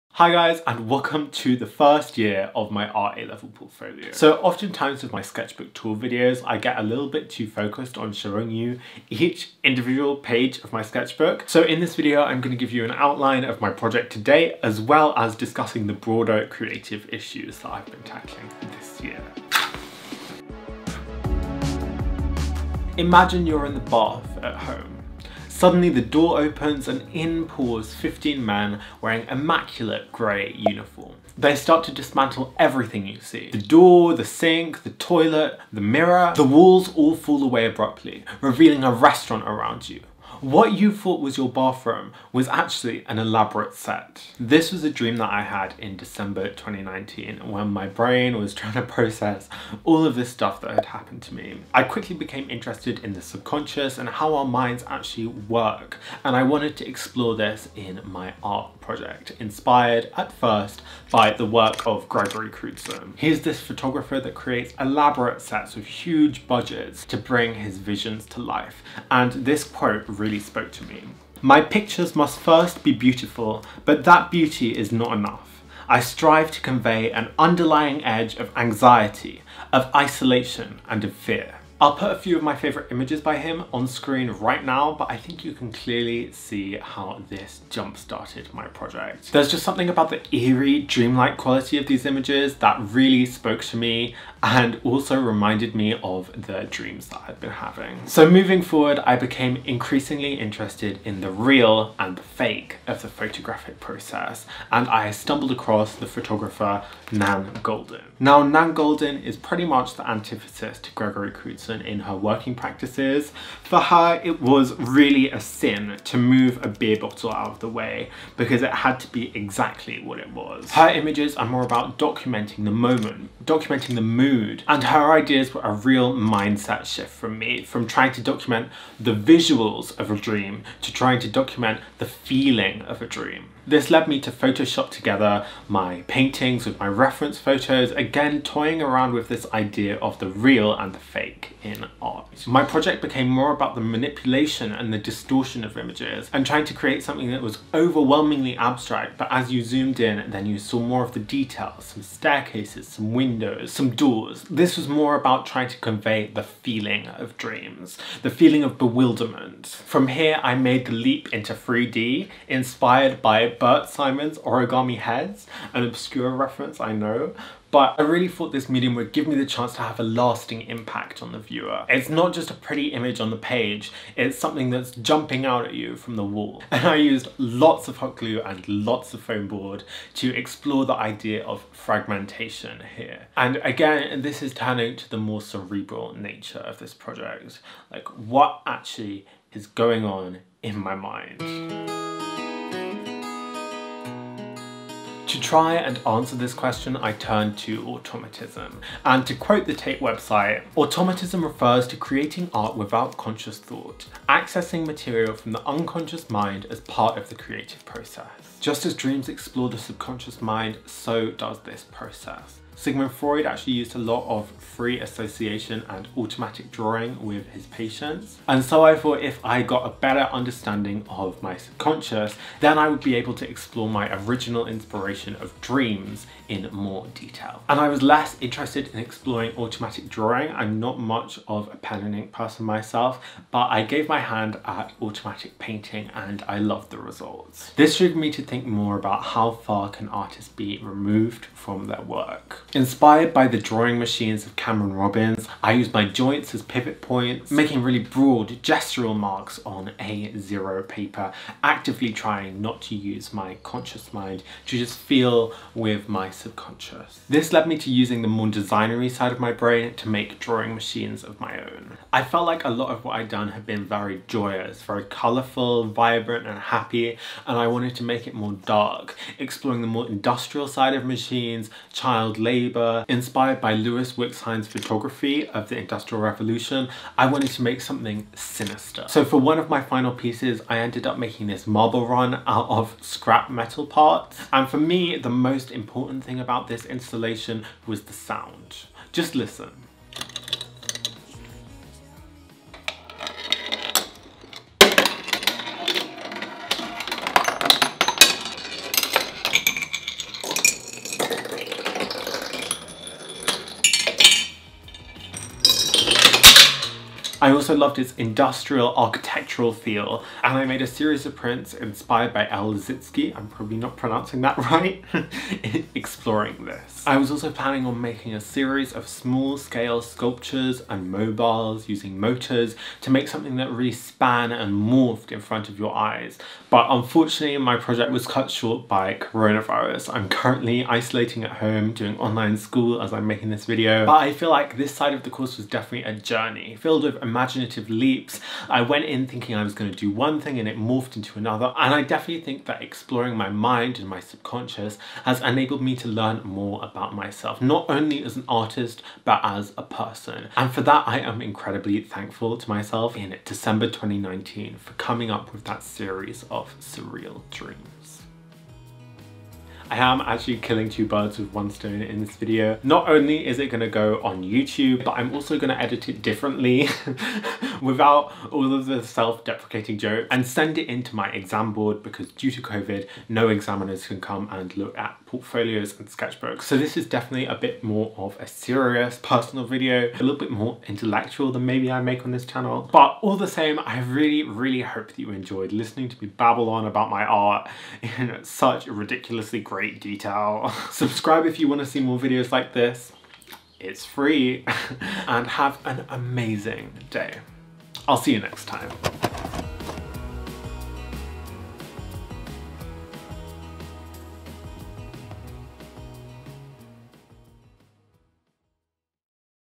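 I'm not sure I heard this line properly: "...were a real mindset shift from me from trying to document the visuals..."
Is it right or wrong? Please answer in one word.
right.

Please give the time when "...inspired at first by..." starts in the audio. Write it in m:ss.
0:59.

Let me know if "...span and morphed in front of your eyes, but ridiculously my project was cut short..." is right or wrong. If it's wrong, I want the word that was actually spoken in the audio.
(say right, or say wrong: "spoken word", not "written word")
wrong: "unfortunately", not "ridiculously".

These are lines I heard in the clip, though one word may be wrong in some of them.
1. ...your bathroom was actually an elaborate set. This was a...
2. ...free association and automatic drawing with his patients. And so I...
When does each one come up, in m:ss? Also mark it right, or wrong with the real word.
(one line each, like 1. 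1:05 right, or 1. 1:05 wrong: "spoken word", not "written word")
1. 0:41 right
2. 3:34 right.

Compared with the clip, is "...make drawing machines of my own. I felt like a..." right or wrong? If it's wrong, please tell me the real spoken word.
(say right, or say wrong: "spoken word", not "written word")
right.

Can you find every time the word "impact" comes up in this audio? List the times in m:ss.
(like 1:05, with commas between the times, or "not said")
2:50.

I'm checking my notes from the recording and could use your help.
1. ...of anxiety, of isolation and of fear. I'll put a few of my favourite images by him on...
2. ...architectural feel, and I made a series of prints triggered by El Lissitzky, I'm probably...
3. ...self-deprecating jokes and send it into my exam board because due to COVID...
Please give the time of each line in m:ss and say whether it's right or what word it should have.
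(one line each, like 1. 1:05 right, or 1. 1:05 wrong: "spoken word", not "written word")
1. 1:18 right
2. 5:08 wrong: "inspired", not "triggered"
3. 6:09 right.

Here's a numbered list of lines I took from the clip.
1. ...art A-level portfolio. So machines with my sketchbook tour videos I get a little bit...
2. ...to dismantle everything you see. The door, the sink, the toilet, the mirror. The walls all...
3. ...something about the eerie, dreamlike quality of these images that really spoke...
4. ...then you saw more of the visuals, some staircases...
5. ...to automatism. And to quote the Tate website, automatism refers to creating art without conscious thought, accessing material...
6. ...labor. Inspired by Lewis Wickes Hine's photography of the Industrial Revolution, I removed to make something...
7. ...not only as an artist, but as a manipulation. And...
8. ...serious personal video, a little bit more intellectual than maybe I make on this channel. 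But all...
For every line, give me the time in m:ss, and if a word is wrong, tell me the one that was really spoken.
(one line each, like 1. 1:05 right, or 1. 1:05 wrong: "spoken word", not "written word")
1. 0:02 wrong: "oftentimes", not "machines"
2. 0:31 right
3. 1:29 right
4. 2:30 wrong: "details", not "visuals"
5. 3:17 right
6. 4:32 wrong: "wanted", not "removed"
7. 5:47 wrong: "person", not "manipulation"
8. 6:18 right.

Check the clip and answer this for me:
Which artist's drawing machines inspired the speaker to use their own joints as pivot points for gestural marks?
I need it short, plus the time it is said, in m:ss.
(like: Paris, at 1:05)
Cameron Robbins, at 4:04.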